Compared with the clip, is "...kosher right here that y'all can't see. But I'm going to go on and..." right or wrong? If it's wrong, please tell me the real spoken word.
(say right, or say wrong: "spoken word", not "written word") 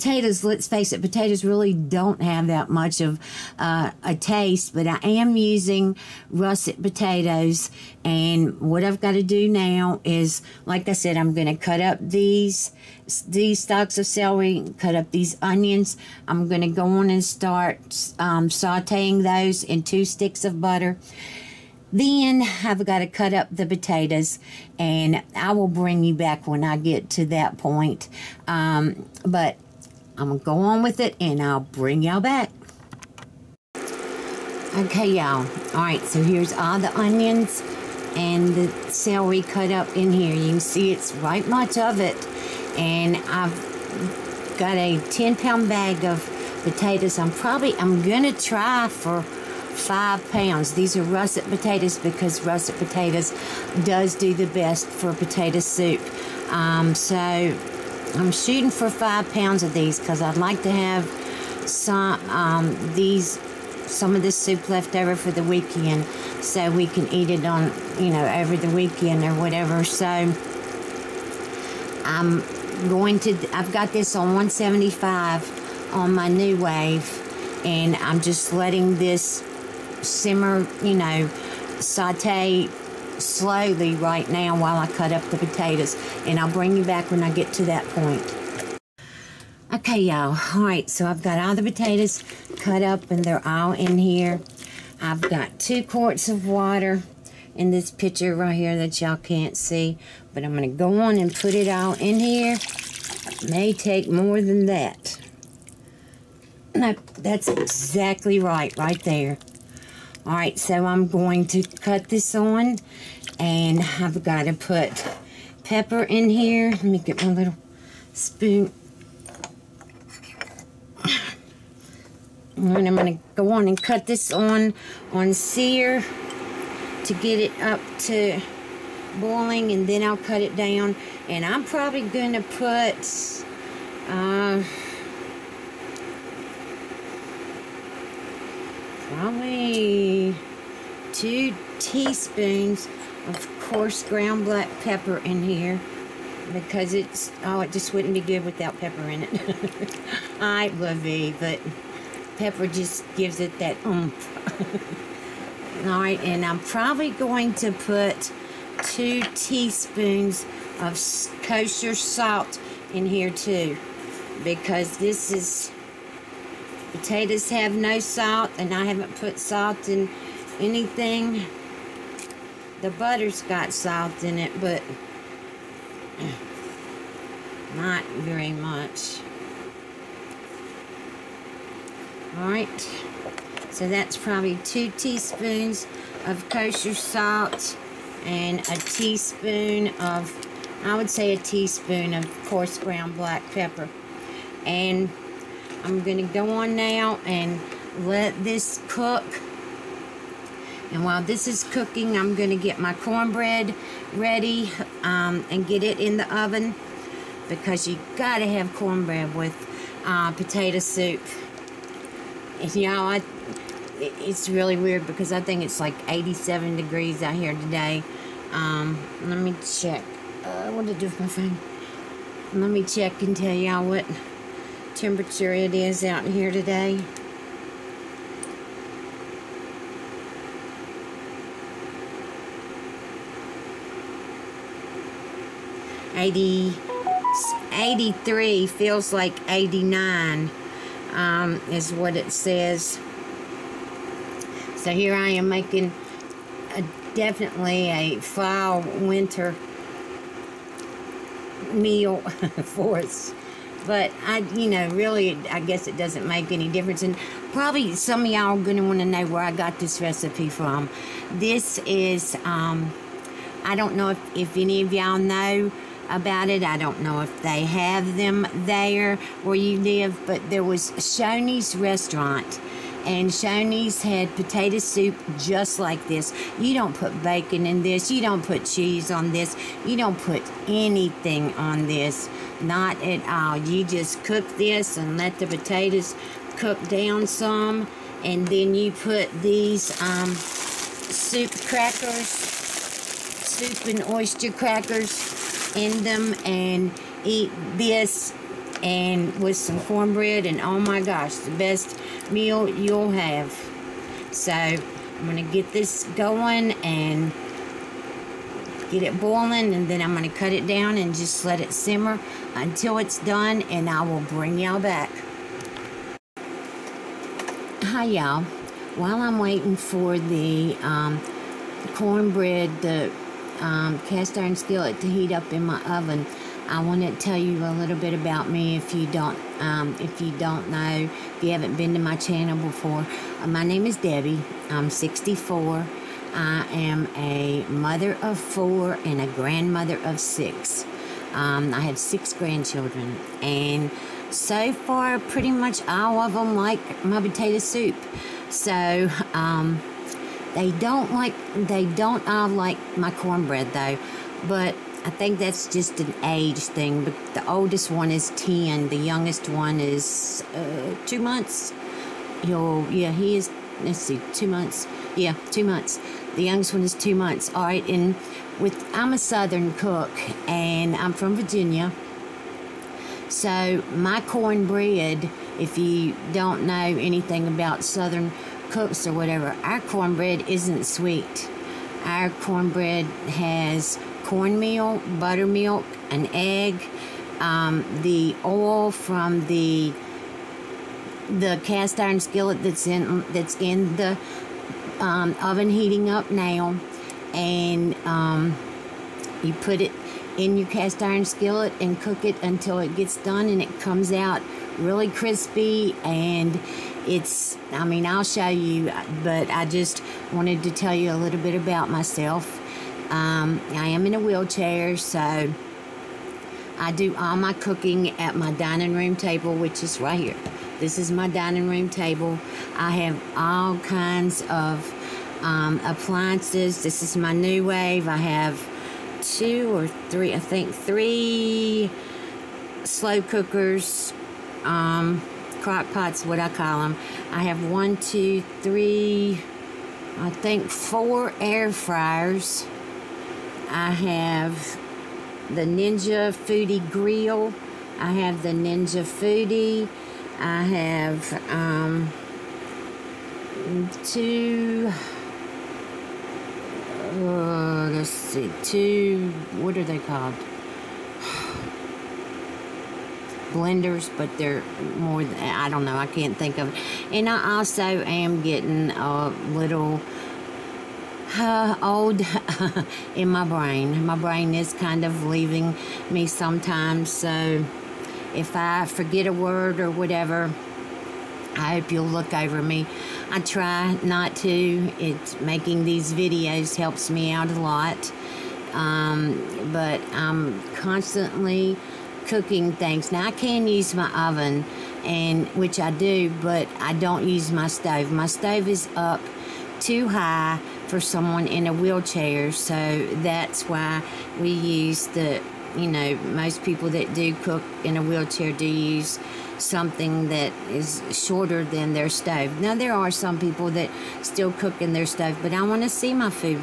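wrong: "pitcher", not "kosher".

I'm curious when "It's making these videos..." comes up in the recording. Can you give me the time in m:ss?
8:04.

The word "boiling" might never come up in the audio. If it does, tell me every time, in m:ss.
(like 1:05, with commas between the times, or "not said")
2:09, 5:09.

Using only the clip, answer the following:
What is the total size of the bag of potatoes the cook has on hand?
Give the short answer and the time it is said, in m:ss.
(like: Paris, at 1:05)
10 pounds, at 0:45.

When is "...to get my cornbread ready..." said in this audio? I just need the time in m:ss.
3:22.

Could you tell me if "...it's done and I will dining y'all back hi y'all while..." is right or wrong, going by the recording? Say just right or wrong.
wrong.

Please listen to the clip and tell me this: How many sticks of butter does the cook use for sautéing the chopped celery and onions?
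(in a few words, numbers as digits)
2.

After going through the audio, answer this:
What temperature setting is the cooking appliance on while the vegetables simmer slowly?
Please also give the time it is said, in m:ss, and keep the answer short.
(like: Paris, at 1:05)
175, at 1:14.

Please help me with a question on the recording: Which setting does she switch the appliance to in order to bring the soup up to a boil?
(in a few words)
sear.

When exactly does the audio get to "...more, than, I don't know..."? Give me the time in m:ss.
7:44.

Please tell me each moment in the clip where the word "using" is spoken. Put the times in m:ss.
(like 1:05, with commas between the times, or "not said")
0:05.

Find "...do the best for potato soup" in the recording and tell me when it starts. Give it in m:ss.
0:54.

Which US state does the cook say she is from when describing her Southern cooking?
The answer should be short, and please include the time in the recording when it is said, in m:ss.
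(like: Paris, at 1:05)
Virginia, at 6:11.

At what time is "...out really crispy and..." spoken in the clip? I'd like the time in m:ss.
6:44.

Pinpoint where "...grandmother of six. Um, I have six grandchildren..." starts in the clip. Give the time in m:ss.
5:39.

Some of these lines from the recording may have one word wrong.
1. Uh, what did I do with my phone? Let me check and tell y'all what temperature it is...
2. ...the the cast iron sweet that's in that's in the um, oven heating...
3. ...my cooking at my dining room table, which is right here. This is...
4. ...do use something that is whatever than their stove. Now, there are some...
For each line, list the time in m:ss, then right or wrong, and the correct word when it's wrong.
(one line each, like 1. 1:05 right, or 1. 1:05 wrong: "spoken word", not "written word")
1. 3:40 right
2. 6:29 wrong: "skillet", not "sweet"
3. 6:57 right
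4. 8:28 wrong: "shorter", not "whatever".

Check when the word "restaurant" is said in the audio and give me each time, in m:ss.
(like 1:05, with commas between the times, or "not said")
4:31.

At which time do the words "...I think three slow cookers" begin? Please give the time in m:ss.
7:10.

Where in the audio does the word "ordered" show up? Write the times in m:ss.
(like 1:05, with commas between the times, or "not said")
not said.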